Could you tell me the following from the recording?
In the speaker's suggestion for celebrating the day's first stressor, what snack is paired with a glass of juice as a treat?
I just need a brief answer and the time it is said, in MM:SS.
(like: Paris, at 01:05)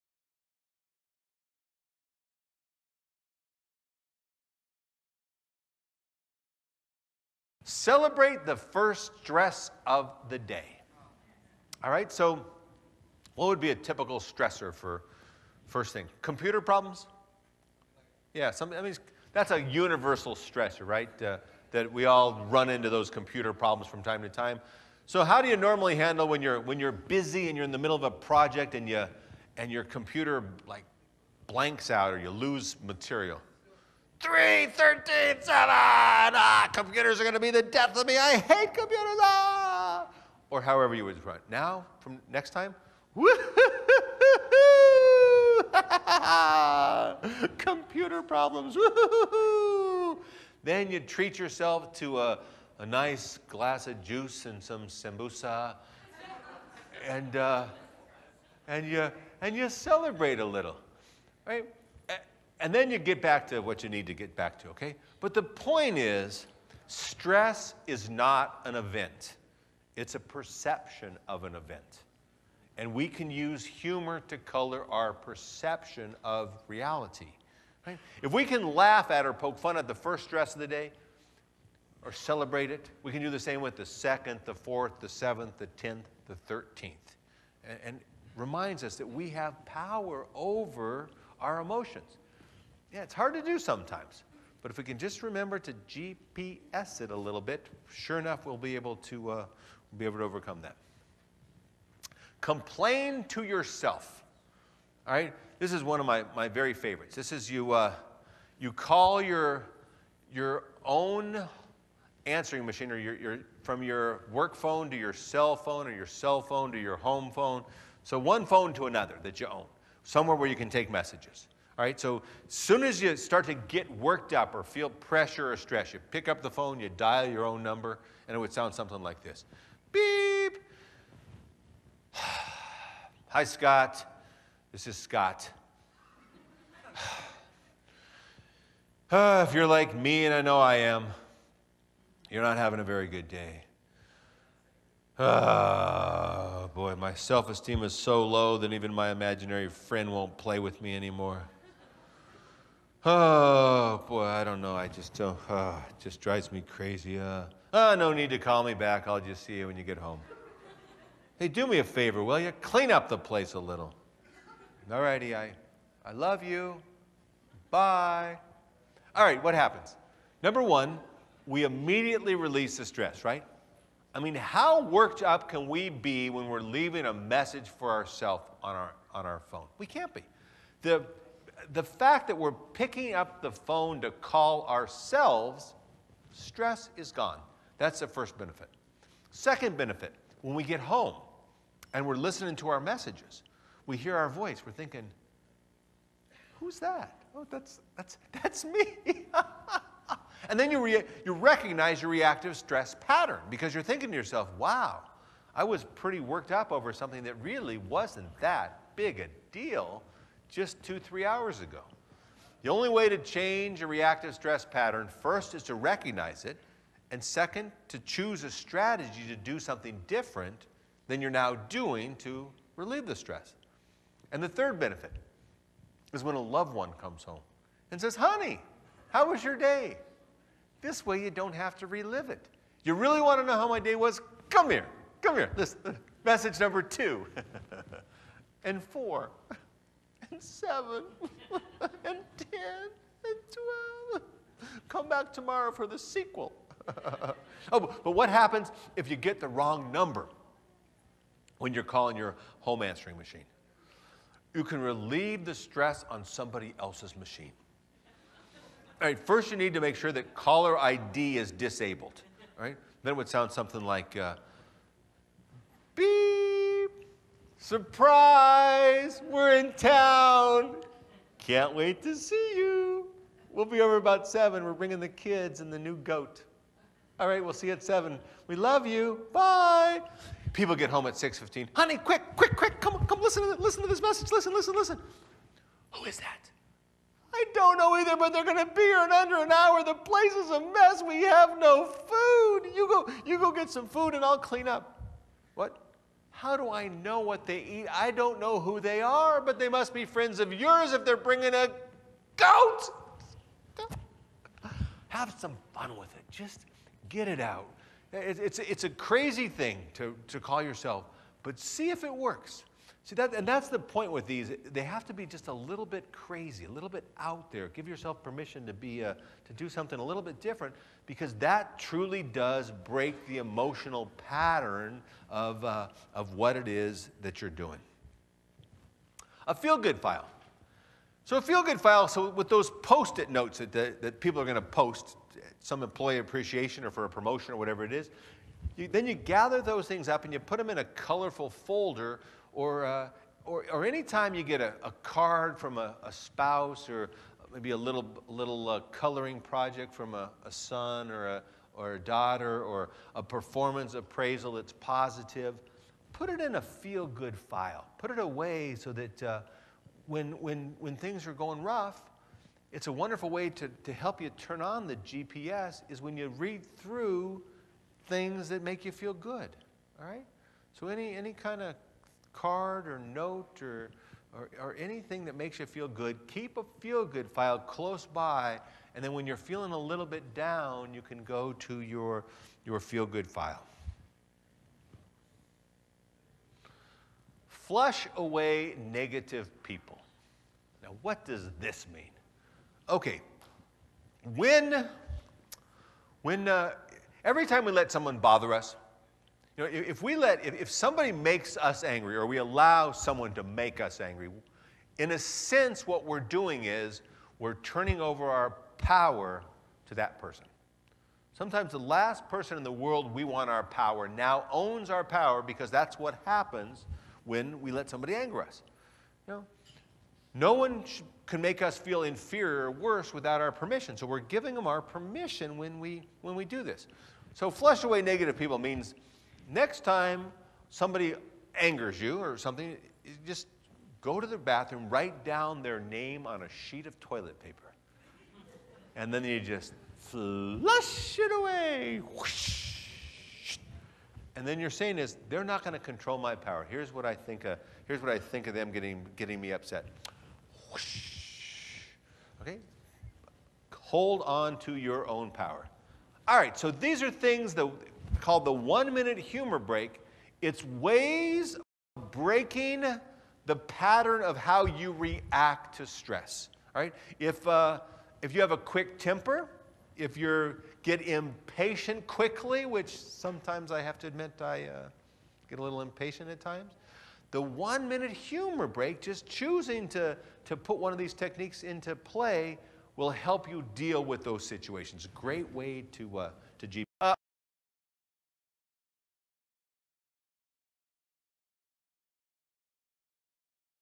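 sambusa, at 00:54.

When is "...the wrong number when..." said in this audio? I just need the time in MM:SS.
04:09.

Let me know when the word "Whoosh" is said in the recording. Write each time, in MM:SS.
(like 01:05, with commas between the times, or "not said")
07:22, 07:30.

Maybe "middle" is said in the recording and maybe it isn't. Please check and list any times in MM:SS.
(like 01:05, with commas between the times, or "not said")
00:27.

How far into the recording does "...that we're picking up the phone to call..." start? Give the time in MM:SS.
03:02.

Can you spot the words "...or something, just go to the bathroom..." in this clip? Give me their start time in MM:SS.
07:12.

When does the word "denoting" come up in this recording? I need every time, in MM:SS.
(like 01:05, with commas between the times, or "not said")
not said.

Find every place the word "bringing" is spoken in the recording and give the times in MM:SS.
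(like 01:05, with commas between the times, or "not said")
04:34, 05:01.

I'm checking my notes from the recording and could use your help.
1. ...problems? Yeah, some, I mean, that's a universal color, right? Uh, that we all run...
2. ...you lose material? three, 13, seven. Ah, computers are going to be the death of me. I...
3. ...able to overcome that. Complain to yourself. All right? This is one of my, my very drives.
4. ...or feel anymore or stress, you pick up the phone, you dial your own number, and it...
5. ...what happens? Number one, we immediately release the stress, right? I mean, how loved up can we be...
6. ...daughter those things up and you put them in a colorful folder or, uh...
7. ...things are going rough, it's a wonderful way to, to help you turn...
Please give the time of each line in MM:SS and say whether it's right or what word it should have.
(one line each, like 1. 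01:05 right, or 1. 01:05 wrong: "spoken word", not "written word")
1. 00:16 wrong: "stressor", not "color"
2. 00:32 right
3. 01:40 wrong: "favorites", not "drives"
4. 02:04 wrong: "pressure", not "anymore"
5. 02:49 wrong: "worked", not "loved"
6. 05:39 wrong: "gather", not "daughter"
7. 06:00 right.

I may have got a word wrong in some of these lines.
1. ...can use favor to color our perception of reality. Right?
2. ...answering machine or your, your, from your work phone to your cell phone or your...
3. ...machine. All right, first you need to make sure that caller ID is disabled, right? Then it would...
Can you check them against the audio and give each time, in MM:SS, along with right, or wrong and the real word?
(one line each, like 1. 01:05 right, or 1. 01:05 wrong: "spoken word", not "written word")
1. 01:13 wrong: "humor", not "favor"
2. 01:52 right
3. 04:17 right.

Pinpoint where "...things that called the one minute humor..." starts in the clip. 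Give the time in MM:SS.
07:37.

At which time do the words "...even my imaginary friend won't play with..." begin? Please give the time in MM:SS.
02:28.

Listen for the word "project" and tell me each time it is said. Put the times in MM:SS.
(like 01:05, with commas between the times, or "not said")
00:28, 05:49.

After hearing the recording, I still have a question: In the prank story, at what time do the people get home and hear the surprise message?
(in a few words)
6:15.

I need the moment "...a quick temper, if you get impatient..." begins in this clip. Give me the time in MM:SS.
07:48.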